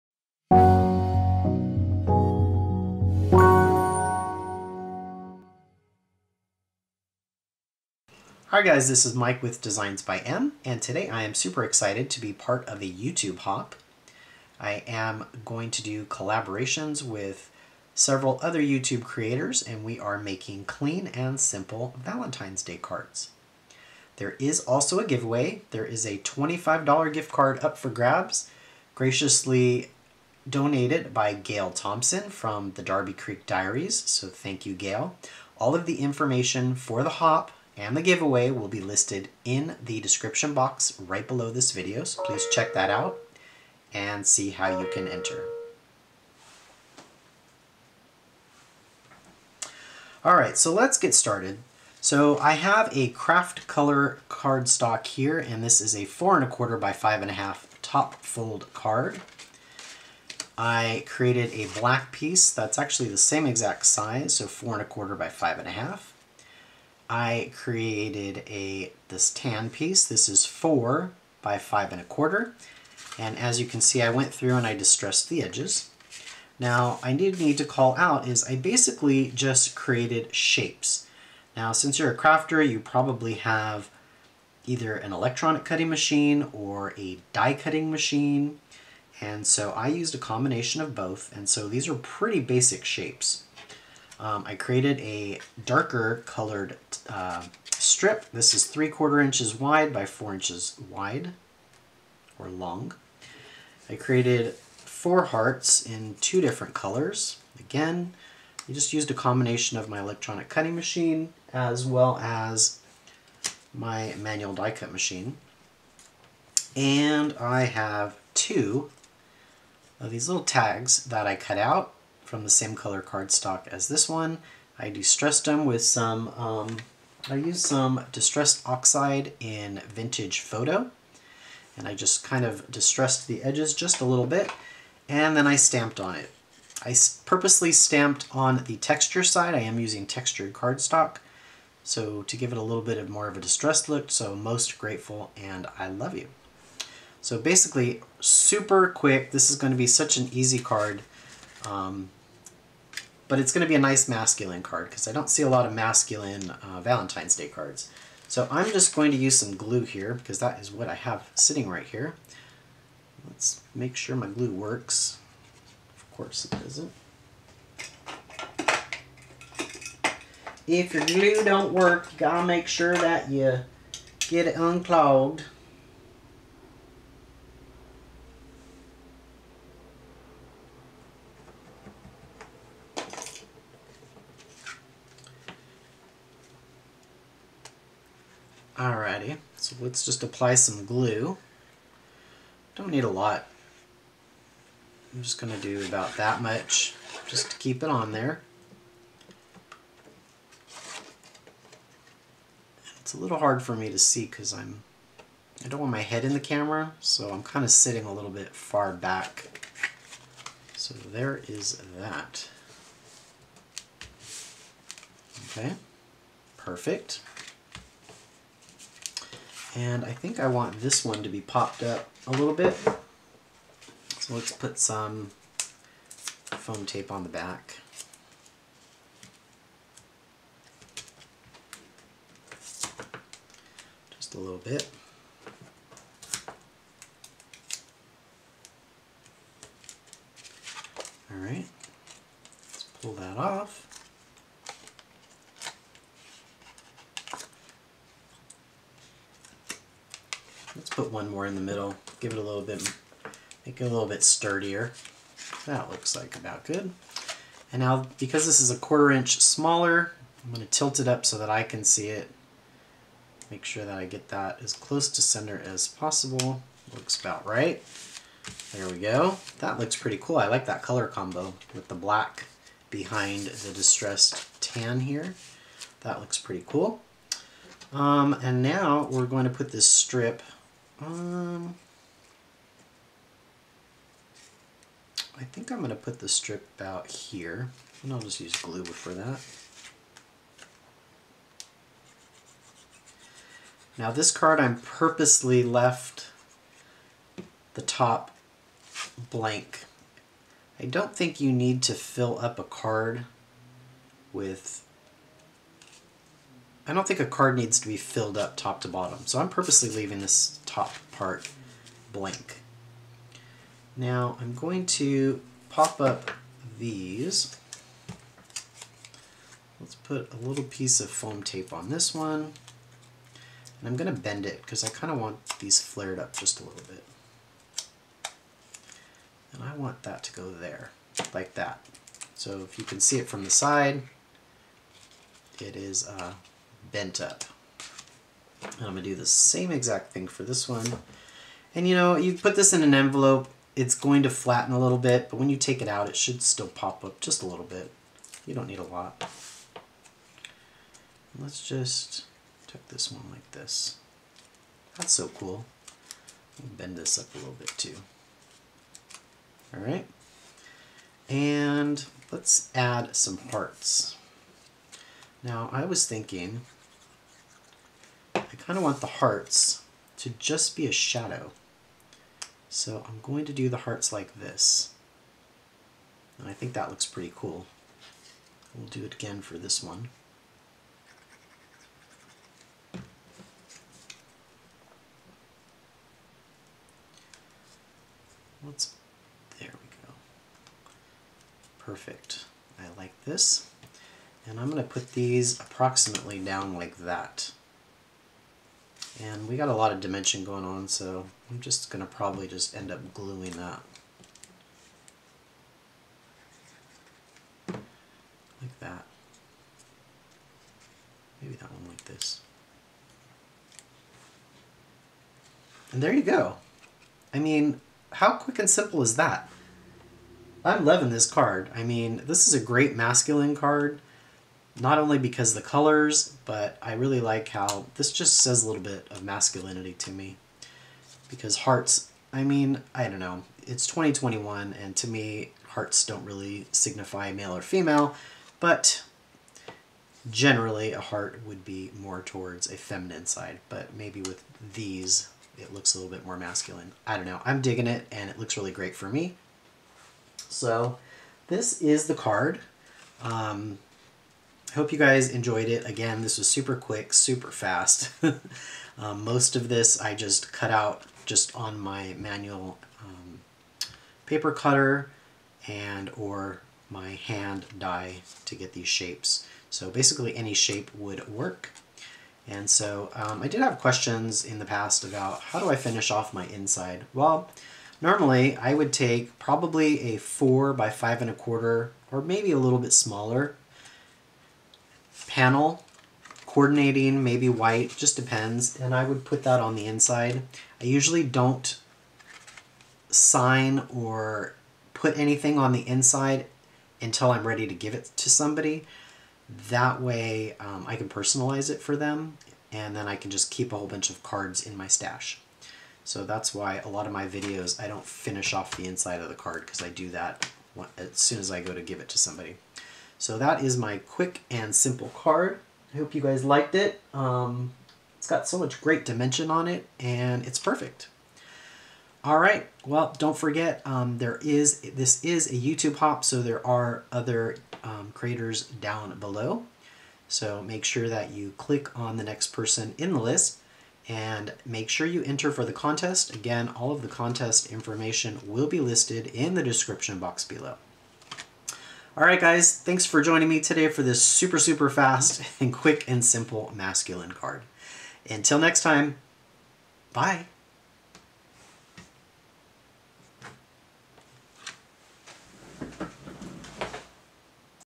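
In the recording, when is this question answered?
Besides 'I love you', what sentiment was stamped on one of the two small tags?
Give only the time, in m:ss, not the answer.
2:24.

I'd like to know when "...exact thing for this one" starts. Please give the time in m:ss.
5:39.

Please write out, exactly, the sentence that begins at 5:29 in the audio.
And I want that to go there, like that.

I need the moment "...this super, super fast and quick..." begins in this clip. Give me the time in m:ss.
9:04.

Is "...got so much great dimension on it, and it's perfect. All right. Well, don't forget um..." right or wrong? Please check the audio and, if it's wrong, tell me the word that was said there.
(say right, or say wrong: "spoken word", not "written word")
right.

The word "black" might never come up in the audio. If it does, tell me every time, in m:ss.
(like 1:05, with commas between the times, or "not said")
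1:01, 4:31.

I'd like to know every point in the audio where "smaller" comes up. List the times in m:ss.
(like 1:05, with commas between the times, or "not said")
4:19, 8:02.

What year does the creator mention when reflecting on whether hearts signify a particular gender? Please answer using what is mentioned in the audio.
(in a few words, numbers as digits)
2021.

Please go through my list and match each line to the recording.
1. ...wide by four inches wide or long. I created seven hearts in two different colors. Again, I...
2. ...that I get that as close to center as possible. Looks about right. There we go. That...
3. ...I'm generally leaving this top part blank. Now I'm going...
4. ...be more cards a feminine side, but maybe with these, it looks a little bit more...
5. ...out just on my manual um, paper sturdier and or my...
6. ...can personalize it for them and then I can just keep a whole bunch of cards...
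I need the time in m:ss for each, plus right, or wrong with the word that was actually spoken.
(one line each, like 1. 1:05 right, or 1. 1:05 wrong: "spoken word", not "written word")
1. 1:39 wrong: "four", not "seven"
2. 4:23 right
3. 5:09 wrong: "purposely", not "generally"
4. 7:21 wrong: "towards", not "cards"
5. 7:40 wrong: "cutter", not "sturdier"
6. 8:20 right.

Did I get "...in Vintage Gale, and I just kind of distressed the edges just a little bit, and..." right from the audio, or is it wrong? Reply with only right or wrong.
wrong.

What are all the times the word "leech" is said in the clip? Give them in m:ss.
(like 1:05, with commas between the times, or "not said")
not said.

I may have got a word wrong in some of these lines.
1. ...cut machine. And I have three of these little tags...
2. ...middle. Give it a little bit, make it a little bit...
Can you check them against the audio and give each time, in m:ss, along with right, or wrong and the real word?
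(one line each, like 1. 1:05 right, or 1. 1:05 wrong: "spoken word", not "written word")
1. 1:54 wrong: "two", not "three"
2. 4:11 right.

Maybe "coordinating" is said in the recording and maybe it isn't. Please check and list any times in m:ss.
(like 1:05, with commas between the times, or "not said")
8:06.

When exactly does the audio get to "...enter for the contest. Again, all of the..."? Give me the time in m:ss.
8:55.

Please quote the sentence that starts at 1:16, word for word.
Now, I did need to call out is I basically just created shapes.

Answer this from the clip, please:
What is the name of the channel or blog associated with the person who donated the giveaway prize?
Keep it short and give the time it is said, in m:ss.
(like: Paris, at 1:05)
Darby Creek Diaries, at 0:32.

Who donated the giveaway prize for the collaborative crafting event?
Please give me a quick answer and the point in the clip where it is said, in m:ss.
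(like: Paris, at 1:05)
Gale Thompson, at 0:31.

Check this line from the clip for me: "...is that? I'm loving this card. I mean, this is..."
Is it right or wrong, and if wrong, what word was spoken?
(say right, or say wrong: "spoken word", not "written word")
right.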